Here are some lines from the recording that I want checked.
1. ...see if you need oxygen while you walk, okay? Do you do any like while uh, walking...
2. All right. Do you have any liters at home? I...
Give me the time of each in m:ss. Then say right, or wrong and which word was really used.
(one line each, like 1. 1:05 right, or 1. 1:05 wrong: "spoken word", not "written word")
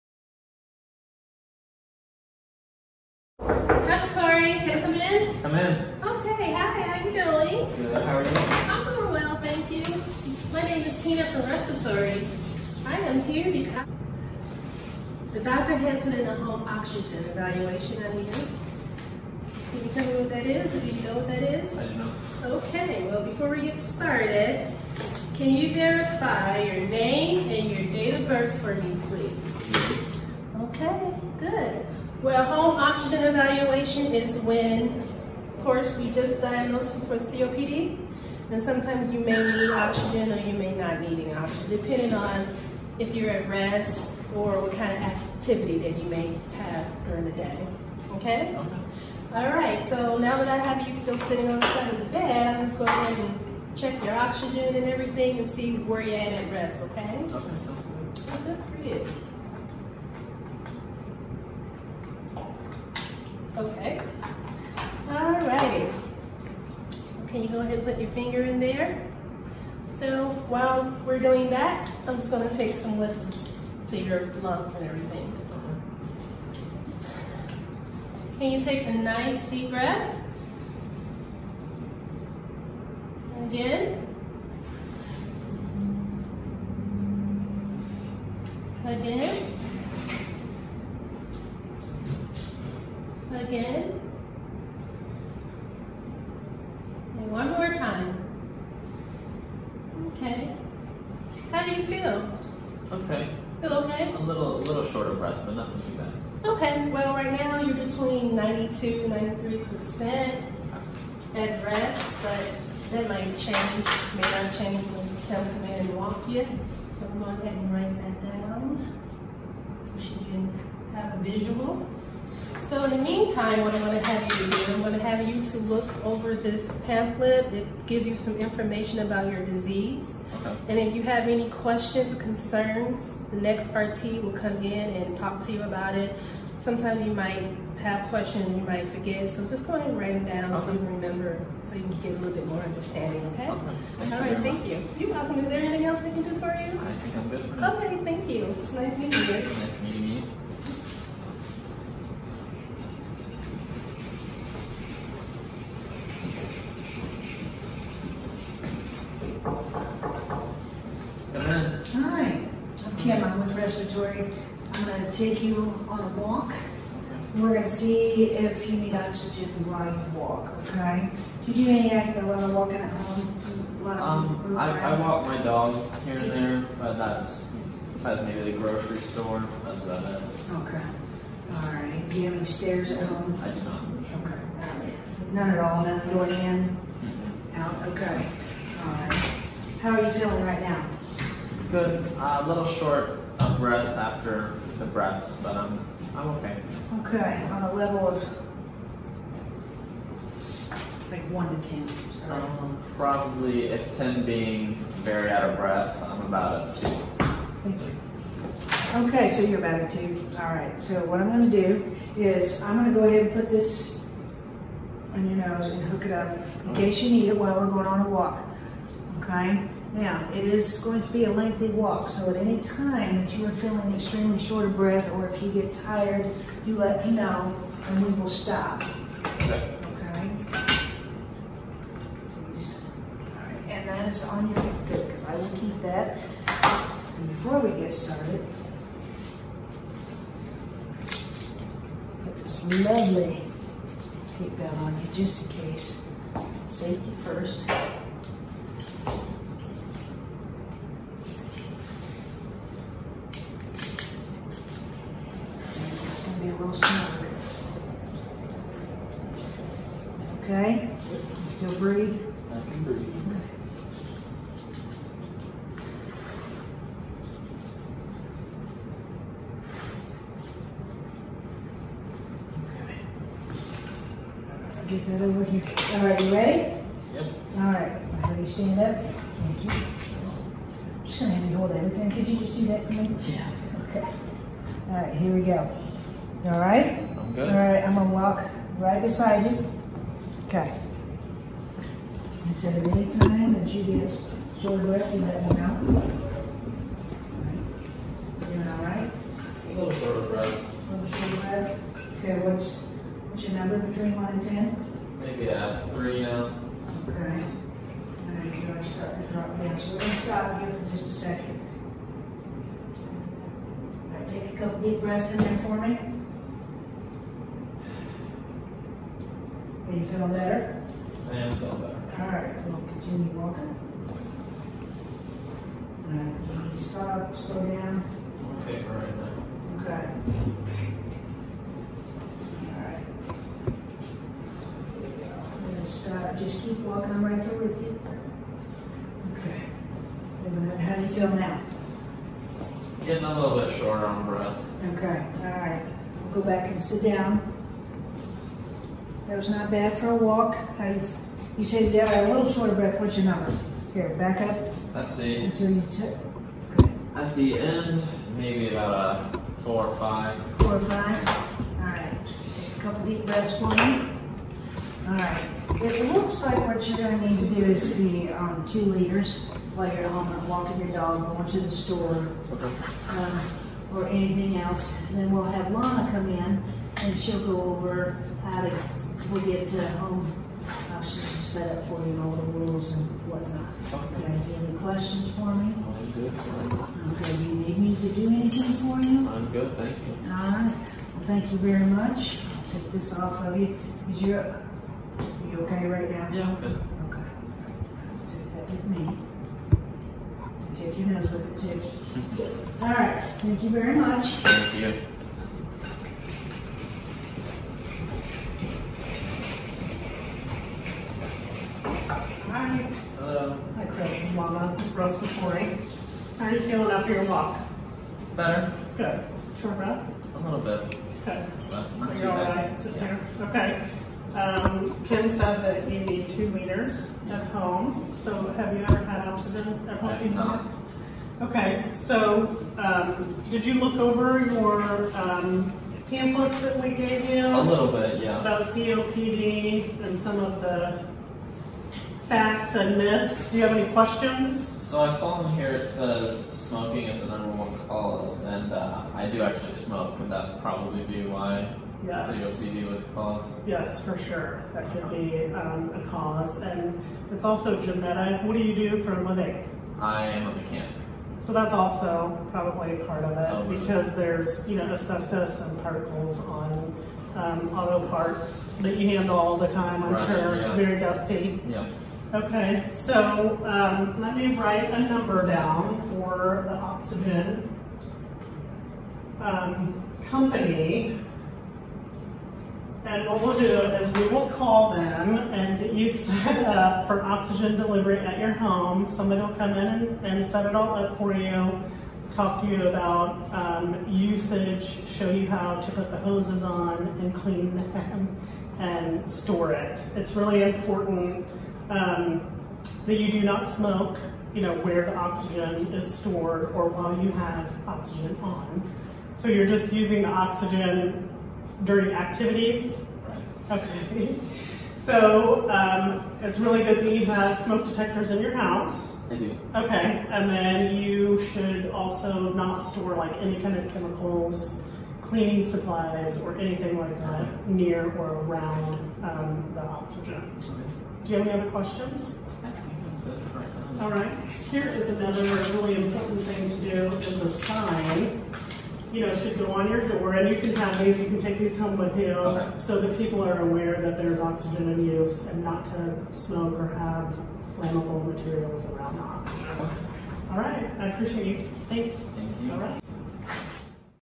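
1. 2:47 right
2. 3:01 wrong: "stairs", not "liters".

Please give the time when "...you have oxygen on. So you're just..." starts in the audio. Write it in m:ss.
8:27.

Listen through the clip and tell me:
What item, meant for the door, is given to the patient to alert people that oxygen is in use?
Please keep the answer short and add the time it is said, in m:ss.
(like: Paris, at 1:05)
A sign, at 8:57.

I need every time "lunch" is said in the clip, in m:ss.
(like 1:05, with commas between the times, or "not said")
not said.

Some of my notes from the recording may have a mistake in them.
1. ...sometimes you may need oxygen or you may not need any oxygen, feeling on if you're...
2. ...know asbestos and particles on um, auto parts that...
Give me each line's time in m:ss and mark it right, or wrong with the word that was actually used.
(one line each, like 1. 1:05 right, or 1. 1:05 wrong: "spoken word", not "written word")
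1. 0:38 wrong: "depending", not "feeling"
2. 7:44 right.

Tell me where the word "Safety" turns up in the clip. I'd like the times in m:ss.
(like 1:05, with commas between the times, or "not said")
4:06.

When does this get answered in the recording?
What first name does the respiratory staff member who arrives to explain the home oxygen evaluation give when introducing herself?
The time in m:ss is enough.
0:11.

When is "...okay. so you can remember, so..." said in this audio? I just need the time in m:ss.
2:20.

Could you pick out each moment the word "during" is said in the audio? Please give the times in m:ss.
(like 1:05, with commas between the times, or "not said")
0:47, 8:31.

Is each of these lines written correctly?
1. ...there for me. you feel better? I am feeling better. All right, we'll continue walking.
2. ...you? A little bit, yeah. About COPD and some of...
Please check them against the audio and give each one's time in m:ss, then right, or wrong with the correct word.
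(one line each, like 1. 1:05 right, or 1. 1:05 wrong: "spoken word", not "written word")
1. 5:15 right
2. 7:17 right.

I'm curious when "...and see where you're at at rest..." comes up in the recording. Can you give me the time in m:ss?
0:55.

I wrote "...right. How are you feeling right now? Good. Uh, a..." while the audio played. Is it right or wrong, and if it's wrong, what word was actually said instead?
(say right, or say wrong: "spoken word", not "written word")
right.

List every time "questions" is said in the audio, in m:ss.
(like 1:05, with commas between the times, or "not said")
2:11, 2:18, 6:24, 7:23, 8:51.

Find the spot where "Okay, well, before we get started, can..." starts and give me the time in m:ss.
0:22.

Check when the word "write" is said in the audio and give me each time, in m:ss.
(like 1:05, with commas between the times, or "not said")
1:57, 2:19, 7:54.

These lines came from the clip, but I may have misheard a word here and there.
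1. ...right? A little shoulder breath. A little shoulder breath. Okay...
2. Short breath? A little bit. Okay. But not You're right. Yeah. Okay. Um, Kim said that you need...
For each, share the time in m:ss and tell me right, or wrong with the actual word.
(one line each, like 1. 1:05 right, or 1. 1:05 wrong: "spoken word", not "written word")
1. 4:58 right
2. 6:59 right.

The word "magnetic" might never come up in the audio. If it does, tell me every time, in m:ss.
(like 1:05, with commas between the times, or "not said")
not said.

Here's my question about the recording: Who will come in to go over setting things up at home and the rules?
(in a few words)
Lana.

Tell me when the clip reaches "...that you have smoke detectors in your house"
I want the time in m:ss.
8:37.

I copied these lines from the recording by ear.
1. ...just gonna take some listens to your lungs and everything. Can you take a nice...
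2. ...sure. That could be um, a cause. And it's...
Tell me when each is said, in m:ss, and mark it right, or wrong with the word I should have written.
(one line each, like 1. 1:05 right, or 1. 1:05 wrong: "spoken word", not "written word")
1. 1:12 right
2. 7:34 right.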